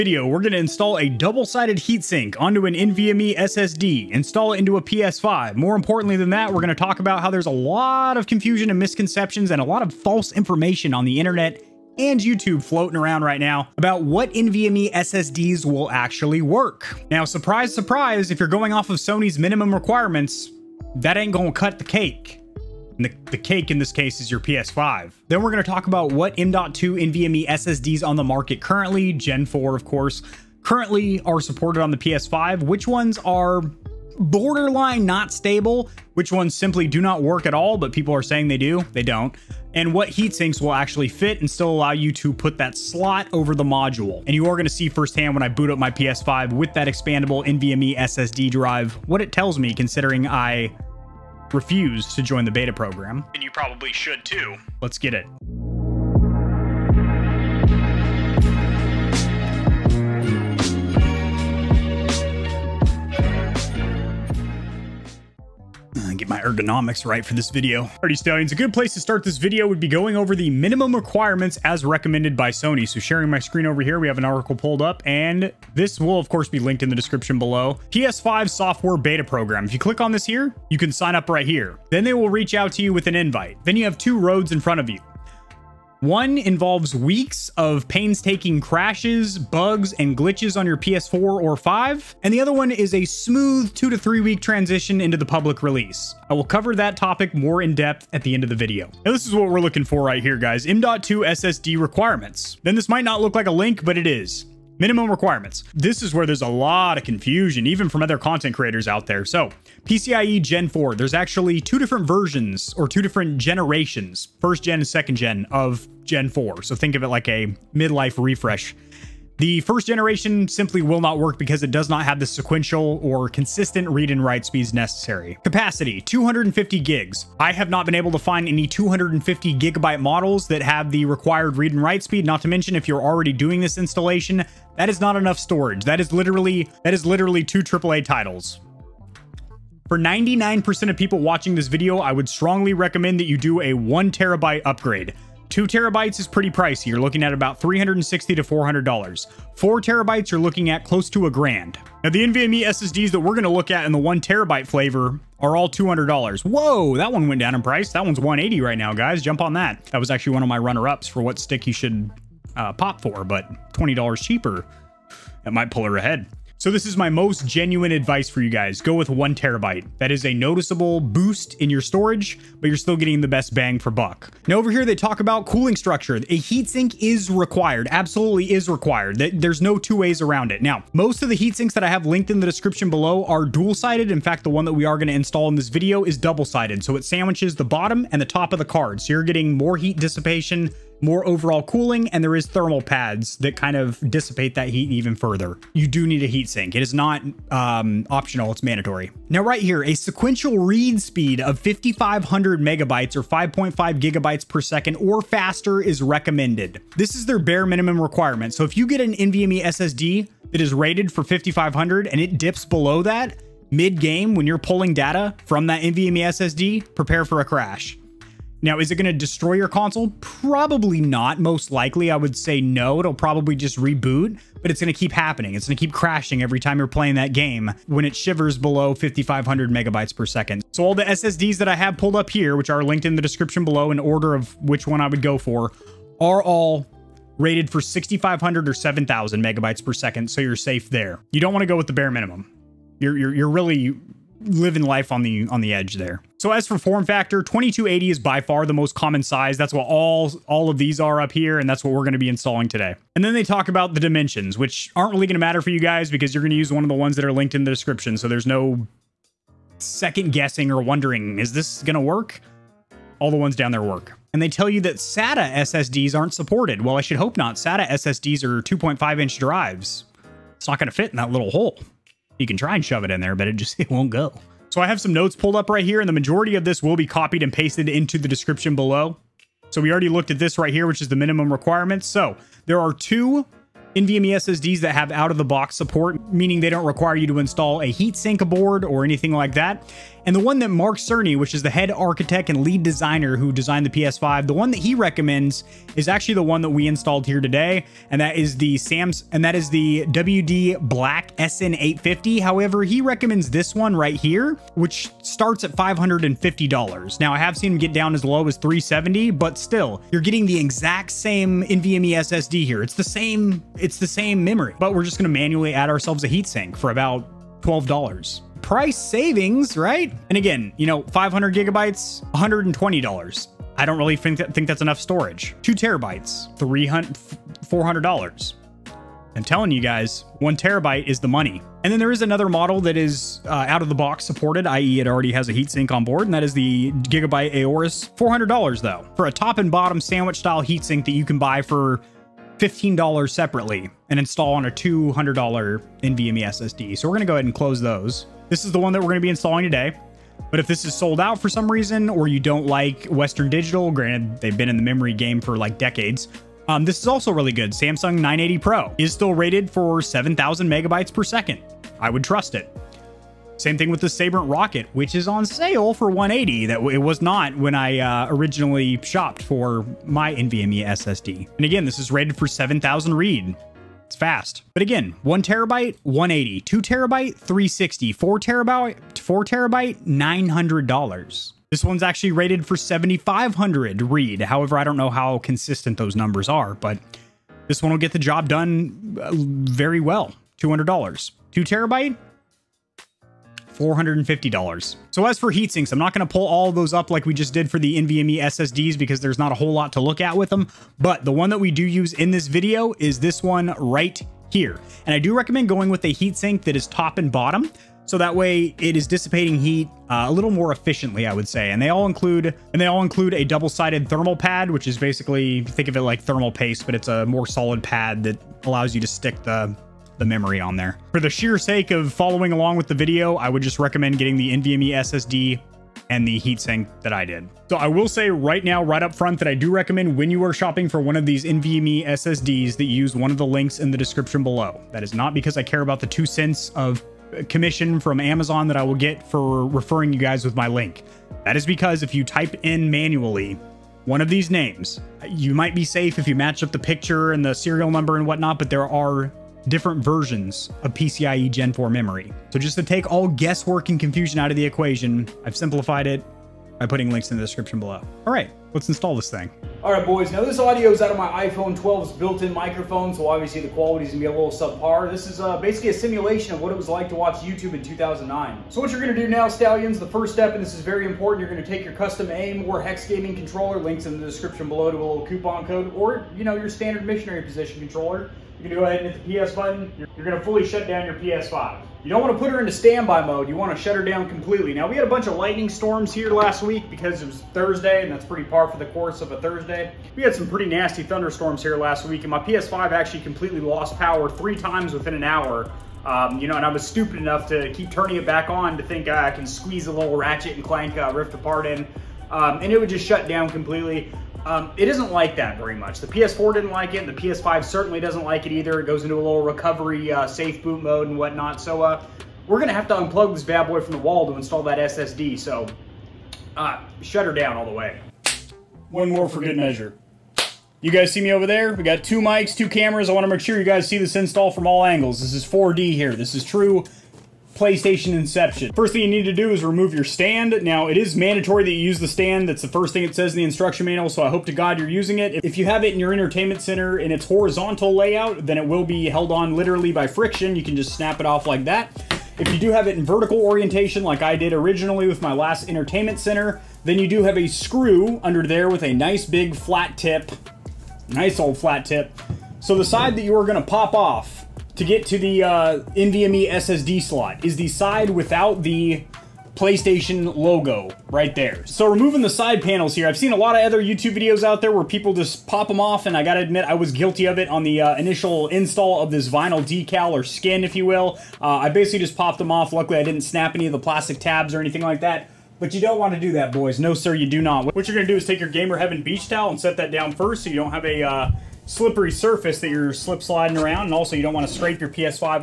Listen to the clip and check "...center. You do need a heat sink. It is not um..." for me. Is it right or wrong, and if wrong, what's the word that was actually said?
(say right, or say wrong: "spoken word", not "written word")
wrong: "further", not "center".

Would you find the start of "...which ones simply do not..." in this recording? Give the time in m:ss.
0:36.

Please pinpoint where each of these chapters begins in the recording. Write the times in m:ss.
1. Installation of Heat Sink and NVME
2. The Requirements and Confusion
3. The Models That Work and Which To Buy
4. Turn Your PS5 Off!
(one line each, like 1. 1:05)
1. 8:39
2. 1:04
3. 4:34
4. 7:37.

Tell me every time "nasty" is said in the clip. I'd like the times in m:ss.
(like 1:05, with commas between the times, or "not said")
8:10.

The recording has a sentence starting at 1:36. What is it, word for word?
I will cover that topic more in depth at the end of the video.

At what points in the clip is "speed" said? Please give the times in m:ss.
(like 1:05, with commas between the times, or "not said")
2:04, 2:12, 3:21.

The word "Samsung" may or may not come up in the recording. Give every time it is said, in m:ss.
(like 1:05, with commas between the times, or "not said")
5:57.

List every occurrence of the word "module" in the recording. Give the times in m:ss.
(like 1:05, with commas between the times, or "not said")
0:43.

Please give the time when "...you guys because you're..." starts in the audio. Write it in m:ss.
4:15.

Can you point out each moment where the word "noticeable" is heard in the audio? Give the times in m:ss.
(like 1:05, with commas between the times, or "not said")
2:50.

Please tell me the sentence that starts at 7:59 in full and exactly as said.
You're, you're gonna fully shut down your PS5.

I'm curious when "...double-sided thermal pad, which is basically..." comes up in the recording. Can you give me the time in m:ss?
6:53.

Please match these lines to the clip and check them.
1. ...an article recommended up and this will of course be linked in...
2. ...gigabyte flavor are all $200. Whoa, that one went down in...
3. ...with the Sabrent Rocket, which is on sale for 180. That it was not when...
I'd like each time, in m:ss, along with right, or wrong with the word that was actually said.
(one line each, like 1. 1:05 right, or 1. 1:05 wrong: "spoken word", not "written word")
1. 1:14 wrong: "pulled", not "recommended"
2. 2:34 wrong: "terabyte", not "gigabyte"
3. 6:03 right.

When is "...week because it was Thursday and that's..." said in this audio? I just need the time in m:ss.
8:06.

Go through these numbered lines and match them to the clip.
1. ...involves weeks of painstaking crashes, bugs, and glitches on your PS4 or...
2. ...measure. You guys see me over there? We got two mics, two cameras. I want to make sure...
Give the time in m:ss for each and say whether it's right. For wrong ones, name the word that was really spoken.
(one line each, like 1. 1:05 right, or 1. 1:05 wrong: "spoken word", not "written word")
1. 1:26 right
2. 8:39 right.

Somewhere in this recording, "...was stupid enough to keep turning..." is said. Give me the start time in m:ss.
8:16.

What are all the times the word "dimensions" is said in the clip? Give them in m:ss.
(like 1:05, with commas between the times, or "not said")
4:13.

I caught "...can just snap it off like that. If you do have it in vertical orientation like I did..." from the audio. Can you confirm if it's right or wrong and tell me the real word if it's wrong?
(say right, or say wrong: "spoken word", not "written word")
right.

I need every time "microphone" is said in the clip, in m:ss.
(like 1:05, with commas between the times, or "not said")
7:42.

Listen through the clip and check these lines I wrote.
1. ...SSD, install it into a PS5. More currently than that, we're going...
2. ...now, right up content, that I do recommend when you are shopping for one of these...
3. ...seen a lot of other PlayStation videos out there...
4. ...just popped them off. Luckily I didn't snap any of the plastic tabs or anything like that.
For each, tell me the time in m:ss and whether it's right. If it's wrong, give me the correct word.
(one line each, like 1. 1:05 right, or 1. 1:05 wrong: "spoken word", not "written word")
1. 0:03 wrong: "importantly", not "currently"
2. 7:08 wrong: "front", not "content"
3. 9:23 wrong: "YouTube", not "PlayStation"
4. 9:31 right.